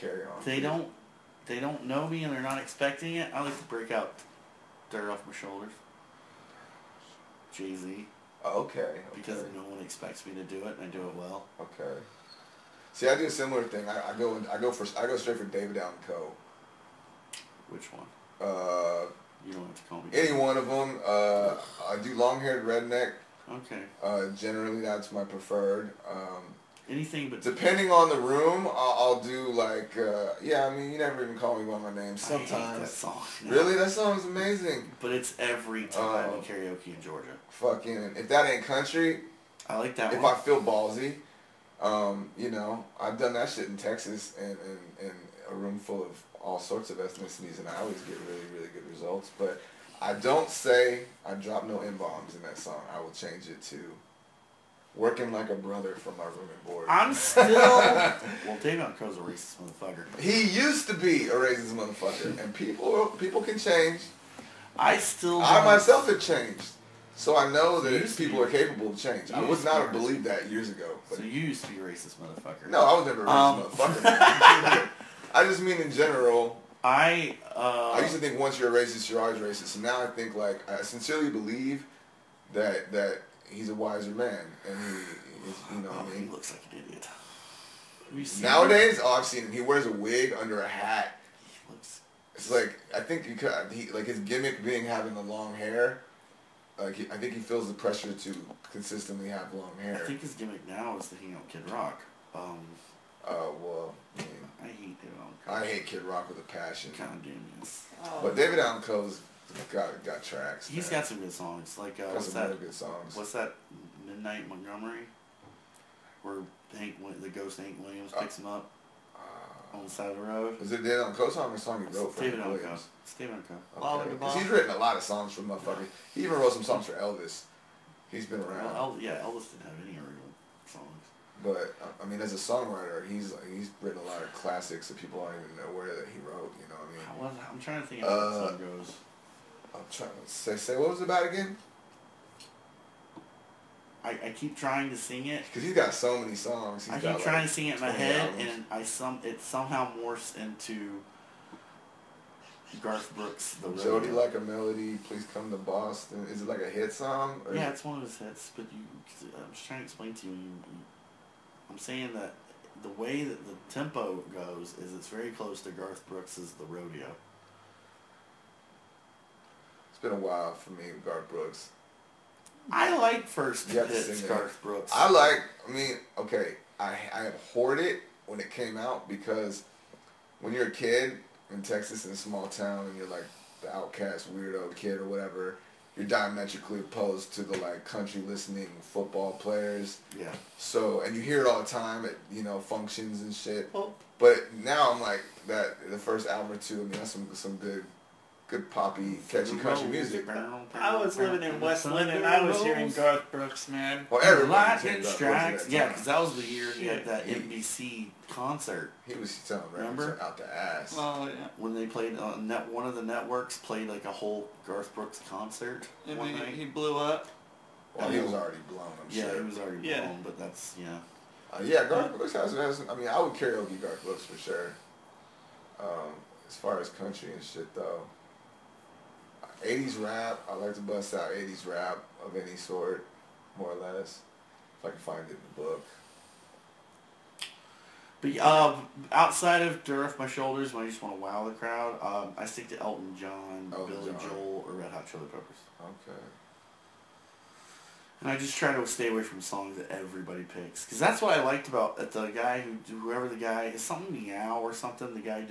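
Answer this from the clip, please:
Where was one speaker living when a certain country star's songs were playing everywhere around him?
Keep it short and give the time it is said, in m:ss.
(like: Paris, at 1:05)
West London, at 3:21.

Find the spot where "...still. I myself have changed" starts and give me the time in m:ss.
1:04.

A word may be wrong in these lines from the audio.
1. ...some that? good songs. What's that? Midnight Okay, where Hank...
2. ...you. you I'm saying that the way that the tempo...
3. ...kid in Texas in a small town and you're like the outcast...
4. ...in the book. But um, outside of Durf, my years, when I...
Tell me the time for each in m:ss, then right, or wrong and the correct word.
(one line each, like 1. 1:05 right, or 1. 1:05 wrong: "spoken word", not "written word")
1. 1:52 wrong: "Montgomery", not "Okay"
2. 2:40 right
3. 3:00 right
4. 3:55 wrong: "shoulders", not "years".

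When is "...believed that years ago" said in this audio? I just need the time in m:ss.
1:09.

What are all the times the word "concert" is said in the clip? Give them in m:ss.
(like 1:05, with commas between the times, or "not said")
3:28, 3:35.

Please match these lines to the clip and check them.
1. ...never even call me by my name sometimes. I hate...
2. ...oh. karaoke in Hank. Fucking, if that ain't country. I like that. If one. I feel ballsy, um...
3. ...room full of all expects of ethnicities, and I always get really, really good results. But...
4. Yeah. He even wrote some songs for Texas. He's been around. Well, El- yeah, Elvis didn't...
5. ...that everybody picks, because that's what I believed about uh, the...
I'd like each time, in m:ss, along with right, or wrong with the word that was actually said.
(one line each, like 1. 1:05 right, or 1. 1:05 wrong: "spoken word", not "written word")
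1. 0:30 right
2. 0:36 wrong: "Georgia", not "Hank"
3. 0:45 wrong: "sorts", not "expects"
4. 2:05 wrong: "Elvis", not "Texas"
5. 4:09 wrong: "liked", not "believed".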